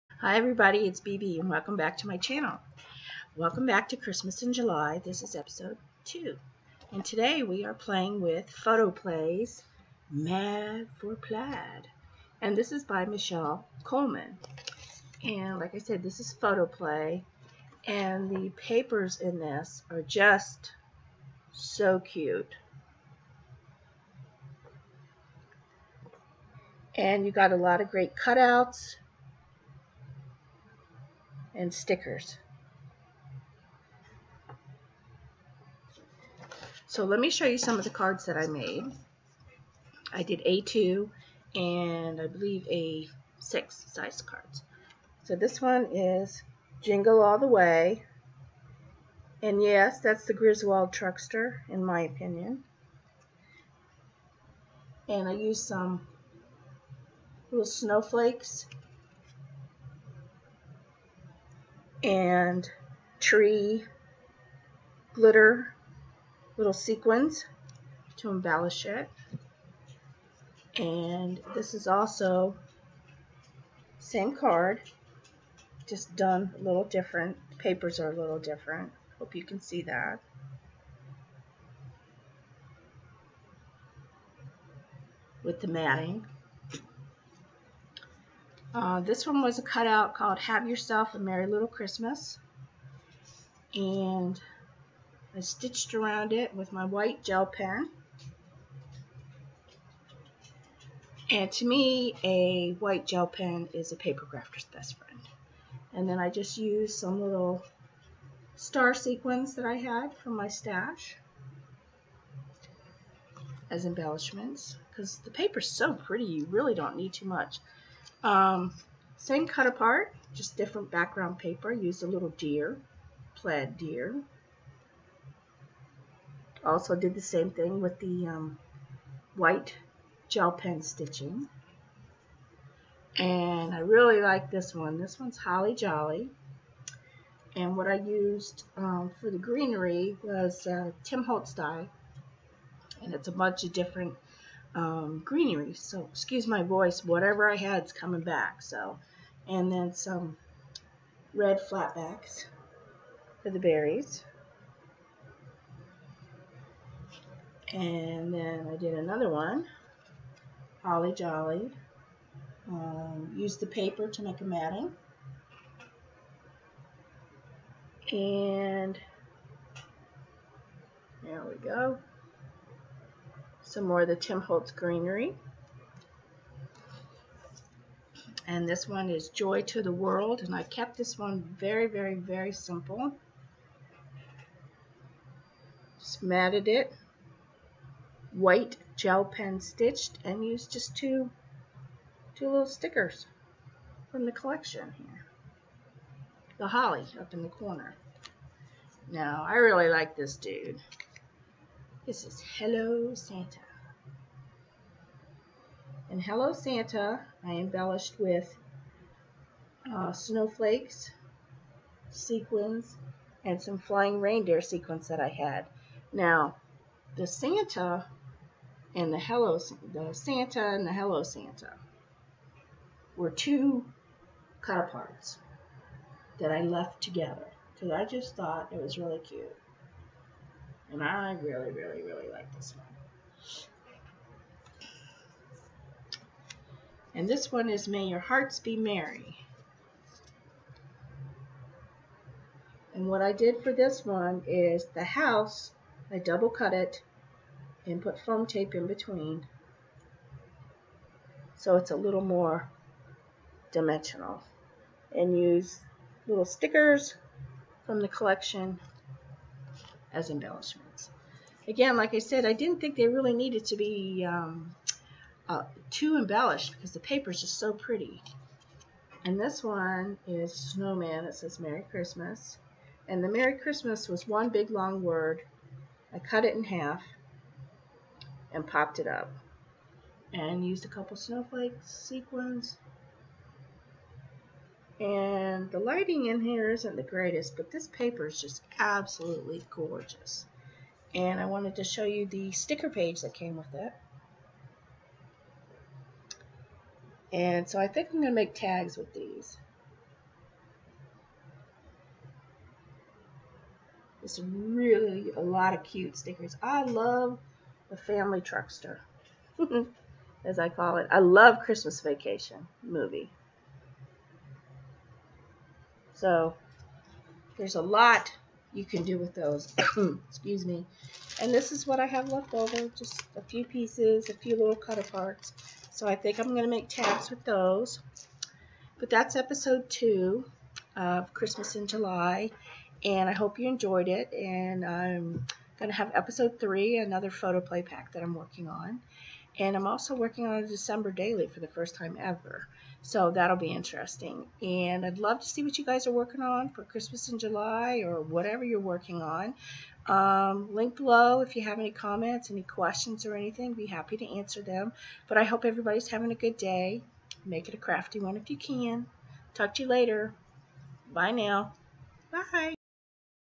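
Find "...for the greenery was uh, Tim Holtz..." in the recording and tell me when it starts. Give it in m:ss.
2:19.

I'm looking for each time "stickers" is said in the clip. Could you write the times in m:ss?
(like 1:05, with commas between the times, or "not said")
0:31, 3:12, 4:16, 4:52, 5:06.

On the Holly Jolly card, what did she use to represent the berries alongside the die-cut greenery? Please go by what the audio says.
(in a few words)
red flatbacks.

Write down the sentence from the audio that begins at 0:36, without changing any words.
So let me show you some of the cards that I made.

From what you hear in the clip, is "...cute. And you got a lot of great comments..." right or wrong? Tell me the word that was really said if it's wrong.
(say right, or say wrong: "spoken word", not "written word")
wrong: "cutouts", not "comments".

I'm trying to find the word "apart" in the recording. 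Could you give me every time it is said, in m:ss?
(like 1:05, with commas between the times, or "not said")
1:59, 3:44.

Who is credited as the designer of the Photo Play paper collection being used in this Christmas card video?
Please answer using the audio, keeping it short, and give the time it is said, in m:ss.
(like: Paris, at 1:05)
Michelle Coleman, at 0:13.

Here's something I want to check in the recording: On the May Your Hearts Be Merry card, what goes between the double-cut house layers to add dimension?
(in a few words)
foam tape.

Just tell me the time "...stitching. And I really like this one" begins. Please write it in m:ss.
2:10.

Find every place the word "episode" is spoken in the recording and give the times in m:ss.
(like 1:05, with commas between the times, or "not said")
0:05, 5:29, 5:36.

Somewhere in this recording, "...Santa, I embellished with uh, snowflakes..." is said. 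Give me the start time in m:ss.
3:26.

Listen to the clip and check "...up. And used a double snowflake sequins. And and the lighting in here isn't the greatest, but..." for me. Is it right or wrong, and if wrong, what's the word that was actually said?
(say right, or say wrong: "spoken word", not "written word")
wrong: "couple", not "double".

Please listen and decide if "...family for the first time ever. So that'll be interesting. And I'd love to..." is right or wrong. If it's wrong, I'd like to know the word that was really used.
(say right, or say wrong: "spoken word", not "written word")
wrong: "daily", not "family".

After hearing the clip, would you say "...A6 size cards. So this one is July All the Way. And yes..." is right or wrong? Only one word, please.
wrong.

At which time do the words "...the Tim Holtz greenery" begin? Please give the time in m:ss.
2:54.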